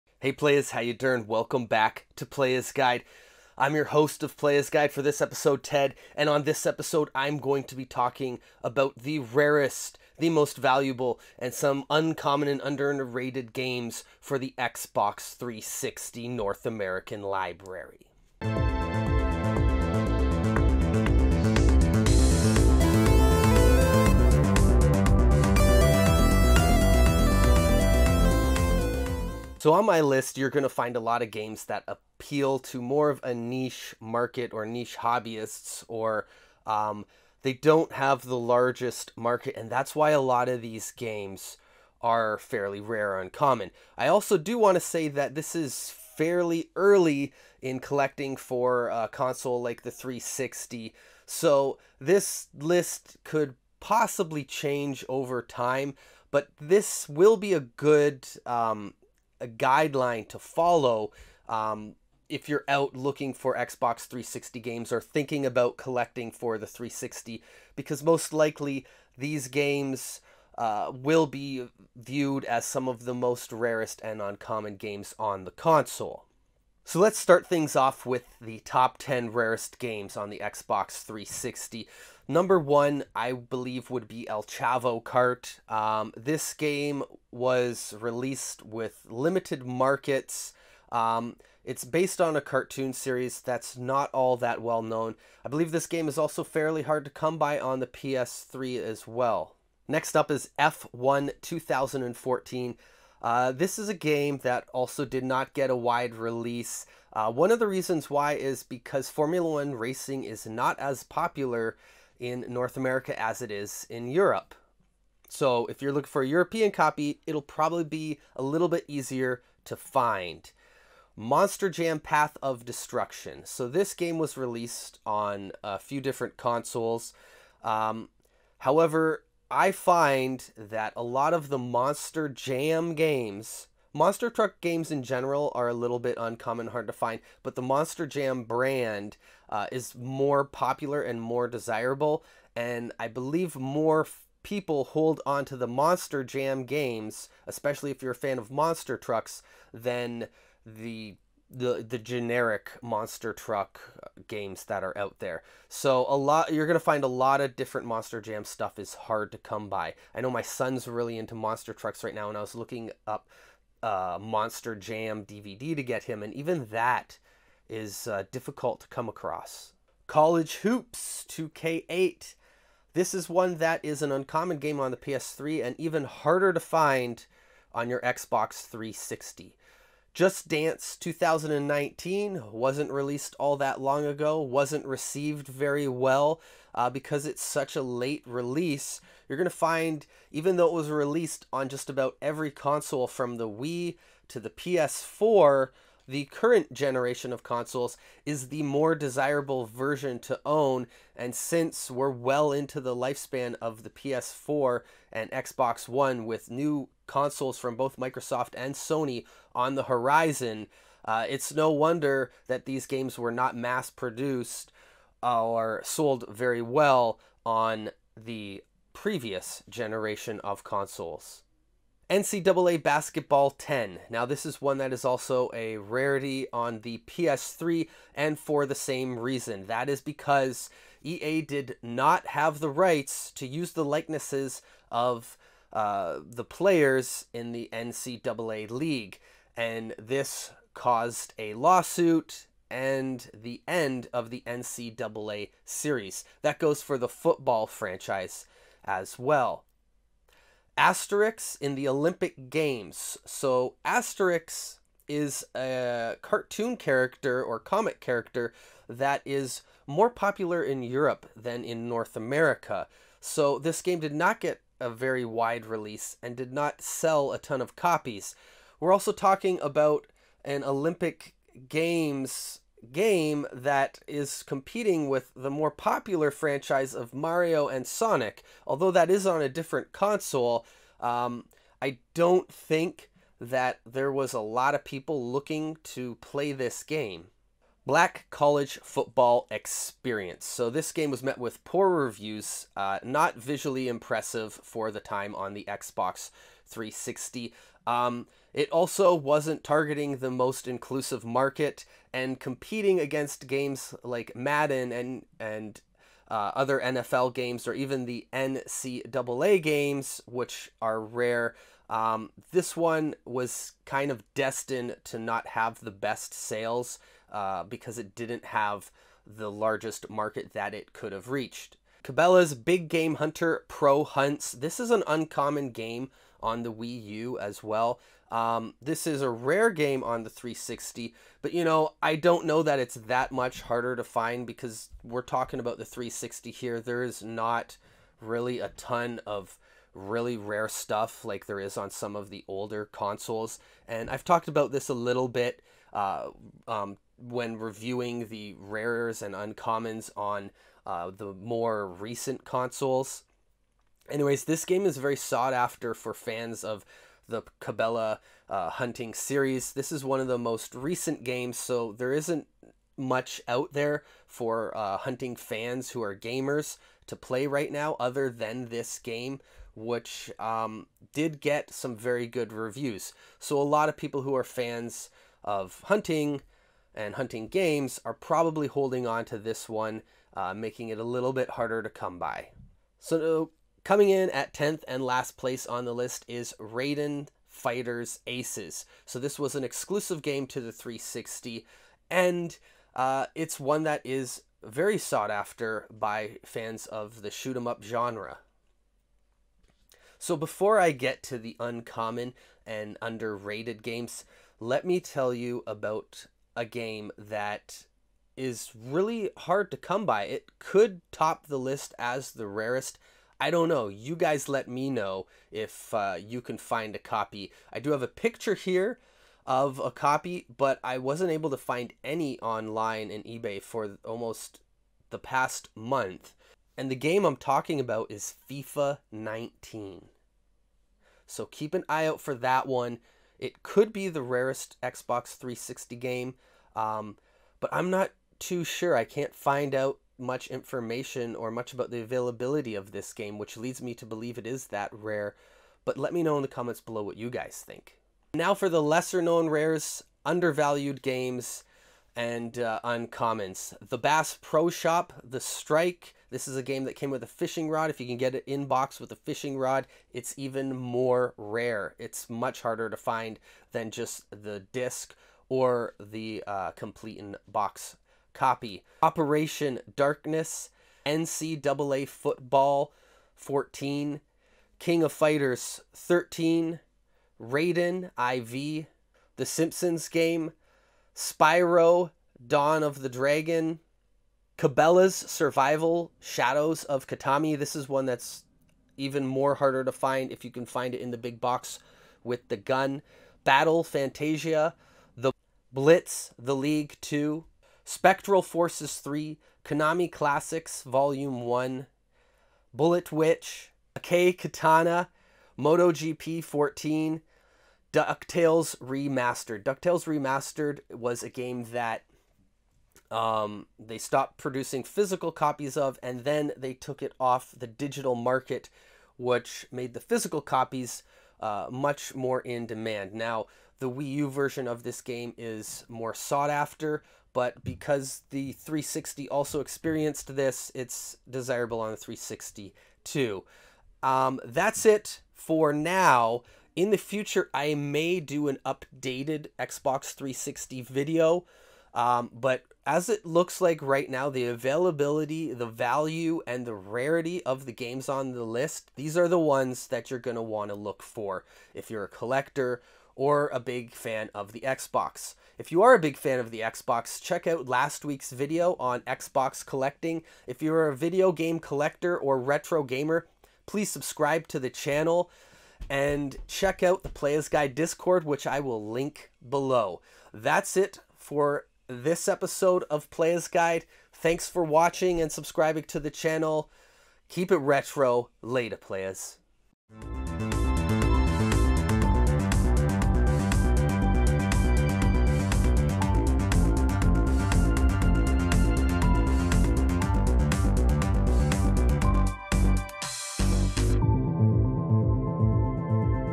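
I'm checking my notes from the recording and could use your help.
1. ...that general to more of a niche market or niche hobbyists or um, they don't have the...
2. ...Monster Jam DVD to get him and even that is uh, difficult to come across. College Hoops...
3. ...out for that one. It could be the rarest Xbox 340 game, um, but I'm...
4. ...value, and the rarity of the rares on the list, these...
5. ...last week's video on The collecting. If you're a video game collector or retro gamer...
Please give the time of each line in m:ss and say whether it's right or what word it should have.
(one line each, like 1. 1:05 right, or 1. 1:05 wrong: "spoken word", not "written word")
1. 0:31 wrong: "appeal", not "general"
2. 2:44 right
3. 7:12 wrong: "360", not "340"
4. 9:05 wrong: "games", not "rares"
5. 9:17 wrong: "Xbox", not "The".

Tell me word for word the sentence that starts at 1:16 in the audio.
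So let's start things off with the top 10 rarest games on the Xbox 360.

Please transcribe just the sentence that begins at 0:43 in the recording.
I also do want to say that this is fairly early in collecting for a console like the 360.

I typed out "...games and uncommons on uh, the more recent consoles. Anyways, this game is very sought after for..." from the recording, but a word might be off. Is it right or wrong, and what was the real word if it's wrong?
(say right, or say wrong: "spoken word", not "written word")
wrong: "rares", not "games".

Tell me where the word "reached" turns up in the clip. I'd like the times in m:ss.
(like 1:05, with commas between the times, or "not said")
5:21.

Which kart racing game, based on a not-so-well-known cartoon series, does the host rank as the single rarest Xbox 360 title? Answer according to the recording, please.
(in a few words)
El Chavo Kart.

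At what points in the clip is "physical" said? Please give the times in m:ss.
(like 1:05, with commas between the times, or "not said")
8:34, 8:39.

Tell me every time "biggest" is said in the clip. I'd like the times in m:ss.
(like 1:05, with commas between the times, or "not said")
not said.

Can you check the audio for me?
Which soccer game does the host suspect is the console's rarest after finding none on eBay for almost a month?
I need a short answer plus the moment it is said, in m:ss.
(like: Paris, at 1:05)
FIFA 19, at 7:08.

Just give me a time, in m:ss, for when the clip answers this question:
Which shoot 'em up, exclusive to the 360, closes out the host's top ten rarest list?
6:26.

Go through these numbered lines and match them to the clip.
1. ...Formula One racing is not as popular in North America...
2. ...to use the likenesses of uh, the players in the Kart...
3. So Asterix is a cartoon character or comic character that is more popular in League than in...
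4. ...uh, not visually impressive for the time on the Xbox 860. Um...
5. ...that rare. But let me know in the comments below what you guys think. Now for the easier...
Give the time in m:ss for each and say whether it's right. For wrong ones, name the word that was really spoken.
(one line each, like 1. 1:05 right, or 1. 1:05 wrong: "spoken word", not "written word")
1. 1:49 right
2. 3:53 wrong: "NCAA", not "Kart"
3. 4:13 wrong: "Europe", not "League"
4. 4:52 wrong: "360", not "860"
5. 7:24 wrong: "lesser", not "easier".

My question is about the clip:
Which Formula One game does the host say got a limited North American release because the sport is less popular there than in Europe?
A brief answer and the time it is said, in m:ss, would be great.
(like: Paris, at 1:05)
F1 2014, at 1:40.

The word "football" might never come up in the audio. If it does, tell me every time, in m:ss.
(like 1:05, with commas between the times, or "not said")
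4:07, 4:48, 7:52.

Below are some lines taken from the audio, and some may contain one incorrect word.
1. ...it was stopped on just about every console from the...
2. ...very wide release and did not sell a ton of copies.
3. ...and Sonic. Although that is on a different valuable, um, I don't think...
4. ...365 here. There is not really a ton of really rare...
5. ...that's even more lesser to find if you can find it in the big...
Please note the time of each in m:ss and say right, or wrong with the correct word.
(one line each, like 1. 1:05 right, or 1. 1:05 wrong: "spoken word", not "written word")
1. 3:10 wrong: "released", not "stopped"
2. 4:24 right
3. 4:37 wrong: "console", not "valuable"
4. 5:35 wrong: "360", not "365"
5. 8:08 wrong: "harder", not "lesser".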